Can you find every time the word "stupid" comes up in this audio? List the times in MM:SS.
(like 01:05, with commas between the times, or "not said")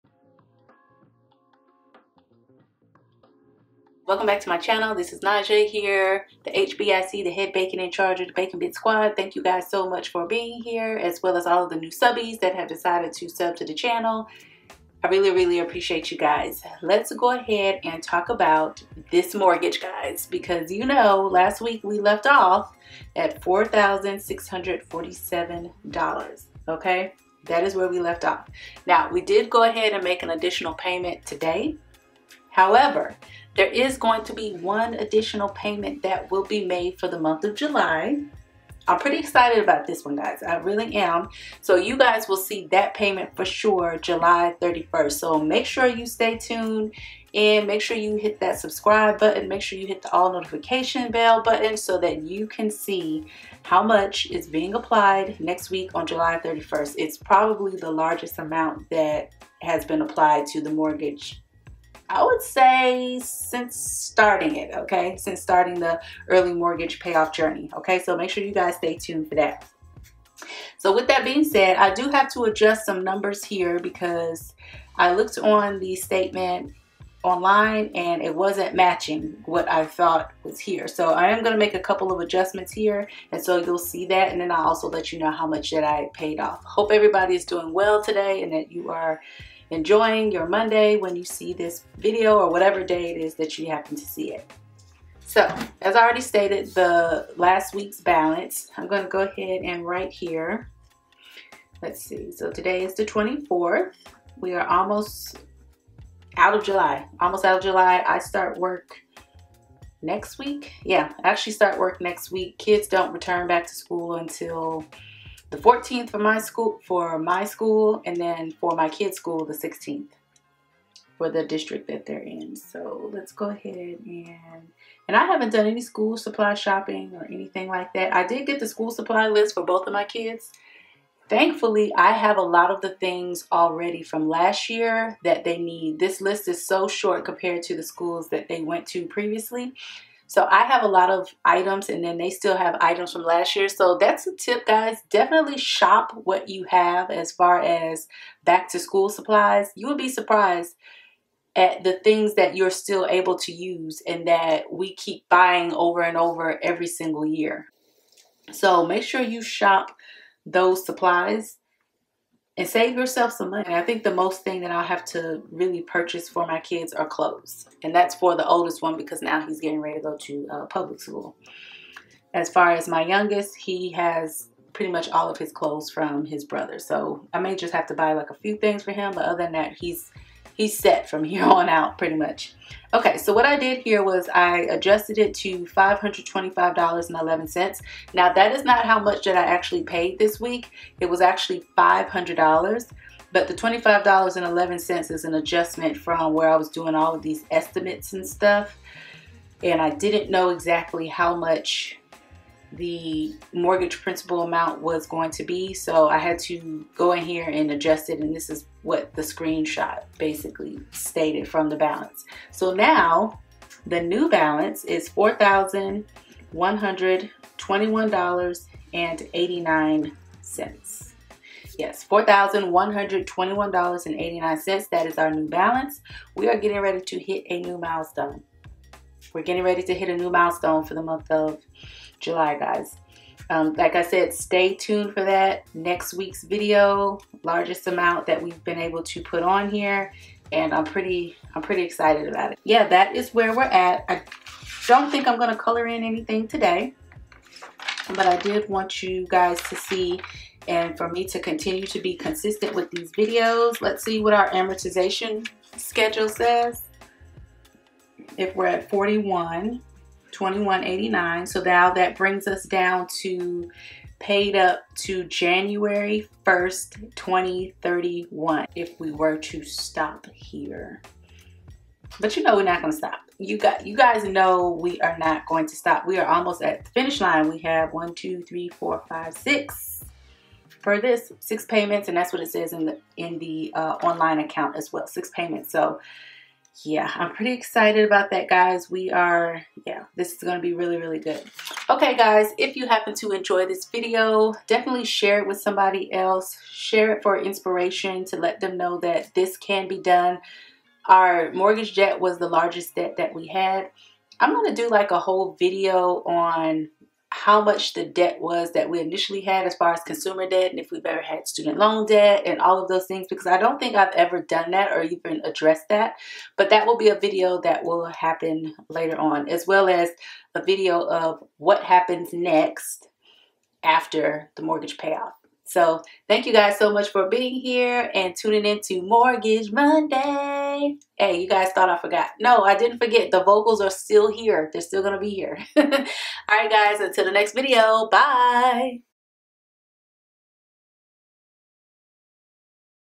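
not said.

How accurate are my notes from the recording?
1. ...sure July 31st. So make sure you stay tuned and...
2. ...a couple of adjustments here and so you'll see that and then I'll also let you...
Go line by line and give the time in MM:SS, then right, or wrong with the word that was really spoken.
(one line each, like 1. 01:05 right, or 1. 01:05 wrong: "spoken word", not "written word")
1. 00:43 right
2. 01:21 right.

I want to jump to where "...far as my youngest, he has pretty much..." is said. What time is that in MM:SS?
02:52.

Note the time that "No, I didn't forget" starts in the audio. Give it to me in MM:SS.
05:32.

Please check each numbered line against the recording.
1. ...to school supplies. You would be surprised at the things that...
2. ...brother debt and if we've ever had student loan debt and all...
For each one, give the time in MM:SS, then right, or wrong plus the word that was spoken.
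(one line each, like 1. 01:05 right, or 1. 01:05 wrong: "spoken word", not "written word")
1. 02:28 right
2. 05:10 wrong: "consumer", not "brother".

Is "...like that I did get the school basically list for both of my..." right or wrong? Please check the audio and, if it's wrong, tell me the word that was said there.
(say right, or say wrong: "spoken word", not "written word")
wrong: "supply", not "basically".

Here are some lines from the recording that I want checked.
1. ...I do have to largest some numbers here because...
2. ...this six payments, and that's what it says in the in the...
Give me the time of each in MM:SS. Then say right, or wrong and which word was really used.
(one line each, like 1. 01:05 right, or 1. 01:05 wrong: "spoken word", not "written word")
1. 01:11 wrong: "adjust", not "largest"
2. 04:41 right.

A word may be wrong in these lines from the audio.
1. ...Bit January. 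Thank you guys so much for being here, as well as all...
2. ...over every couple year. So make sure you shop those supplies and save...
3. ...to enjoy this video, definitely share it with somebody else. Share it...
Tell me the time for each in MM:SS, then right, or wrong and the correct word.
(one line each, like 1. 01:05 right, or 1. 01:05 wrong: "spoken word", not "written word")
1. 00:08 wrong: "Squad", not "January"
2. 02:36 wrong: "single", not "couple"
3. 04:53 right.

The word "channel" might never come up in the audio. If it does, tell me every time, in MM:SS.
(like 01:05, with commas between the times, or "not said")
00:04, 00:13.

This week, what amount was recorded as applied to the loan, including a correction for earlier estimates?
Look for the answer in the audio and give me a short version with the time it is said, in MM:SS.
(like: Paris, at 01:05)
$525.11, at 03:05.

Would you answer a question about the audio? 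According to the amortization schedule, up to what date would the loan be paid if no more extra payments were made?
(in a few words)
January 1st, 2031.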